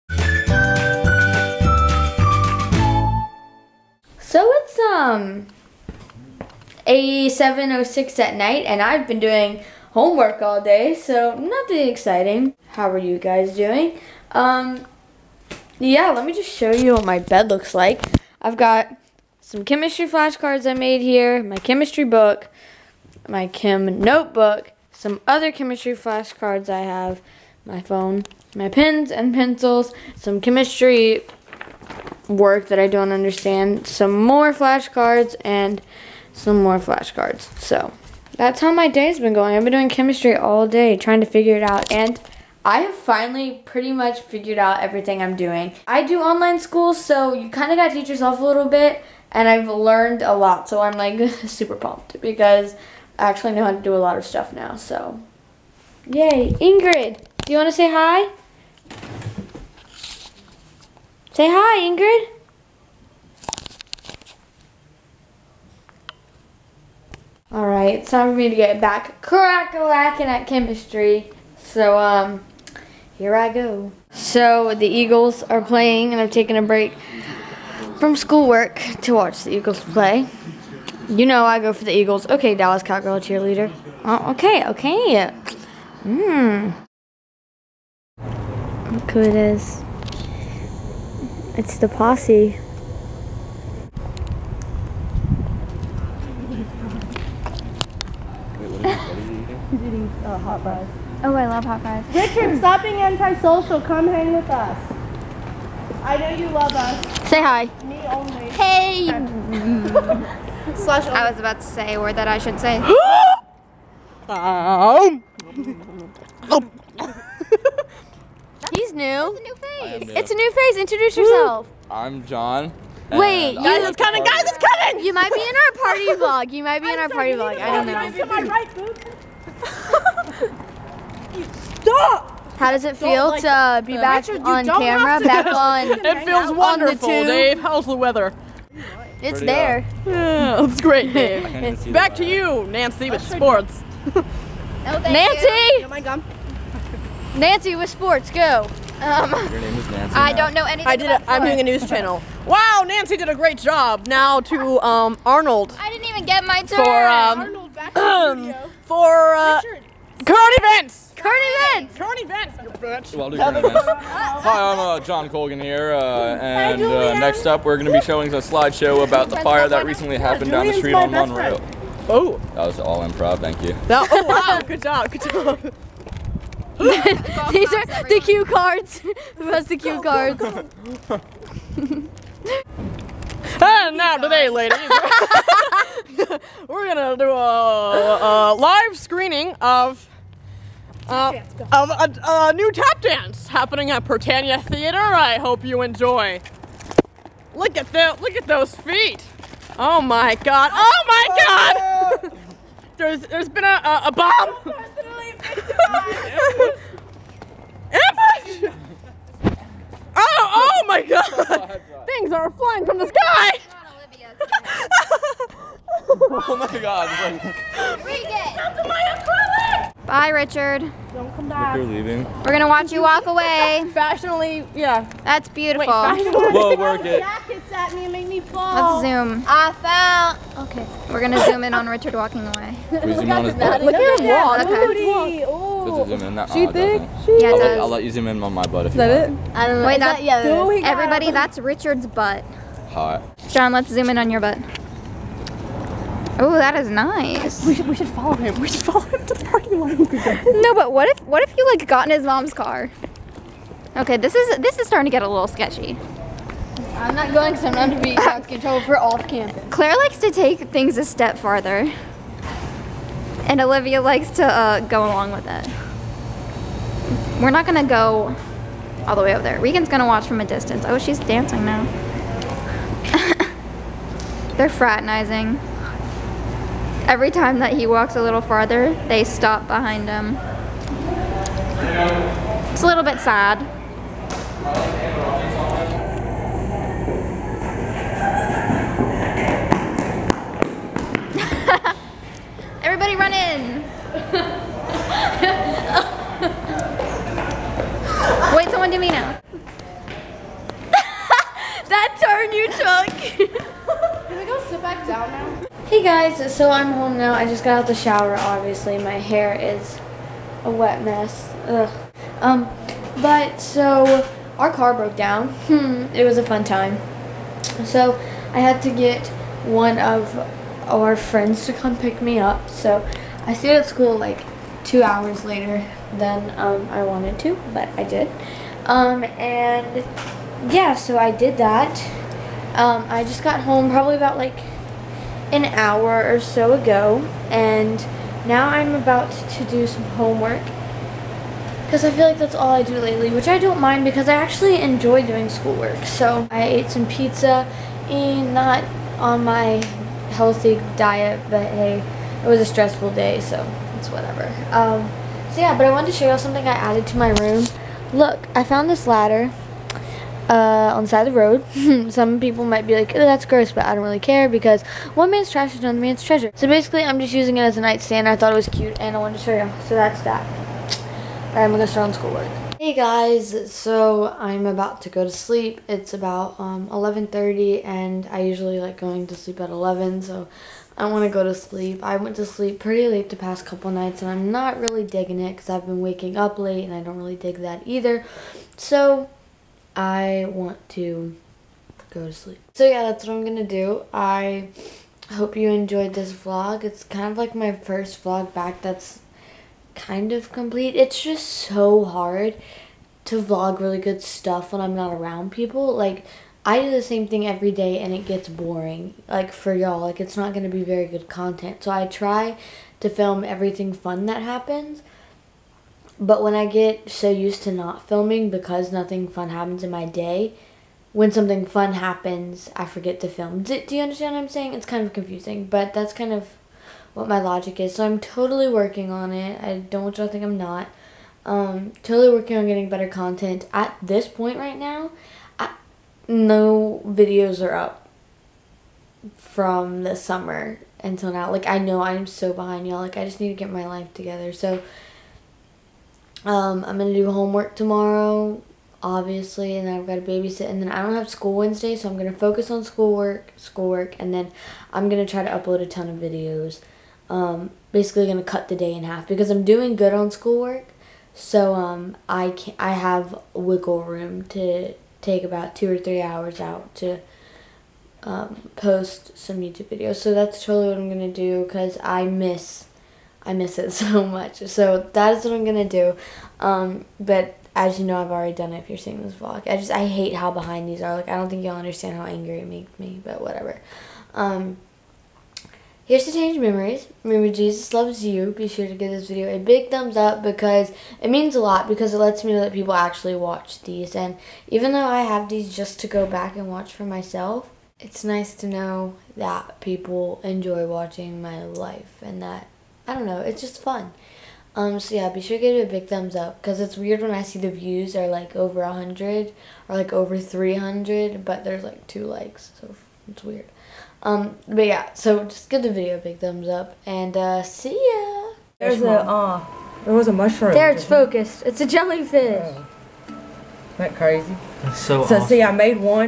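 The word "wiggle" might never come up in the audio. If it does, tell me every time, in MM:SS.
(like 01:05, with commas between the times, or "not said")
07:43.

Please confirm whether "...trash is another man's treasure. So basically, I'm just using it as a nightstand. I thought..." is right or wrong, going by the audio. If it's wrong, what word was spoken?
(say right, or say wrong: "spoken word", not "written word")
right.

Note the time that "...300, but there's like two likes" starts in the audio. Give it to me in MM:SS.
08:30.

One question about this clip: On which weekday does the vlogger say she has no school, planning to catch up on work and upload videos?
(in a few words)
Wednesday.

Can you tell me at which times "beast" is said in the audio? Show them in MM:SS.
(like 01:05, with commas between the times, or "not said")
not said.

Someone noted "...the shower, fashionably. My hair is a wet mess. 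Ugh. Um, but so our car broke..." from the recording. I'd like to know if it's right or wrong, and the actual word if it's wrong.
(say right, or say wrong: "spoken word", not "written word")
wrong: "obviously", not "fashionably".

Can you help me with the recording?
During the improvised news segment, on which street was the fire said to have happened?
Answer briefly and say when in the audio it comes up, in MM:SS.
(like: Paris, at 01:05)
Monroe, at 02:51.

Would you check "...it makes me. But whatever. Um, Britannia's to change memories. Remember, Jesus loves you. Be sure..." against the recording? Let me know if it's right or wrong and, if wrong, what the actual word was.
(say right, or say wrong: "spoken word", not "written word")
wrong: "Here", not "Britannia".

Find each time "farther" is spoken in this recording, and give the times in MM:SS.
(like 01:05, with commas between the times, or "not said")
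04:21, 04:38.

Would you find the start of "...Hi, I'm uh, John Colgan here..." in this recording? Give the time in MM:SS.
02:44.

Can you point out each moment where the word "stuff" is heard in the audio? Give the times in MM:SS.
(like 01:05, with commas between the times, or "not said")
00:54, 06:44.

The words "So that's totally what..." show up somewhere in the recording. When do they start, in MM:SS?
07:50.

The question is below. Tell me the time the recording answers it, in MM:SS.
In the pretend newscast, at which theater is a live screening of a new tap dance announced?
03:14.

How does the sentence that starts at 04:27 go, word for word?
We're not gonna go all the way over there.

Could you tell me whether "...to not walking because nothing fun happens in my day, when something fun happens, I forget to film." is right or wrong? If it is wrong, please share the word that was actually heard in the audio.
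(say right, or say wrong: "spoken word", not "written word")
wrong: "filming", not "walking".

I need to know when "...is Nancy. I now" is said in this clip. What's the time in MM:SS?
02:29.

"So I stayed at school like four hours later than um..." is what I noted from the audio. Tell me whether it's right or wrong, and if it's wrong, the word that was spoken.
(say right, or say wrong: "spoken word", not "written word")
wrong: "two", not "four".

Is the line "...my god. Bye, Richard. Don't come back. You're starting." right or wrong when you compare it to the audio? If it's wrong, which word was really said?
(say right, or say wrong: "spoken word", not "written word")
wrong: "leaving", not "starting".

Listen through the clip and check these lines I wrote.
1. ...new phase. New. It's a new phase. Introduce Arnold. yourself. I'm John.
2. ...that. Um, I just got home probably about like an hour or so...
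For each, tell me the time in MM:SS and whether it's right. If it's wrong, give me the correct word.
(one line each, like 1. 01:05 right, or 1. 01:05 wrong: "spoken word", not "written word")
1. 01:59 wrong: "Woo", not "Arnold"
2. 05:31 right.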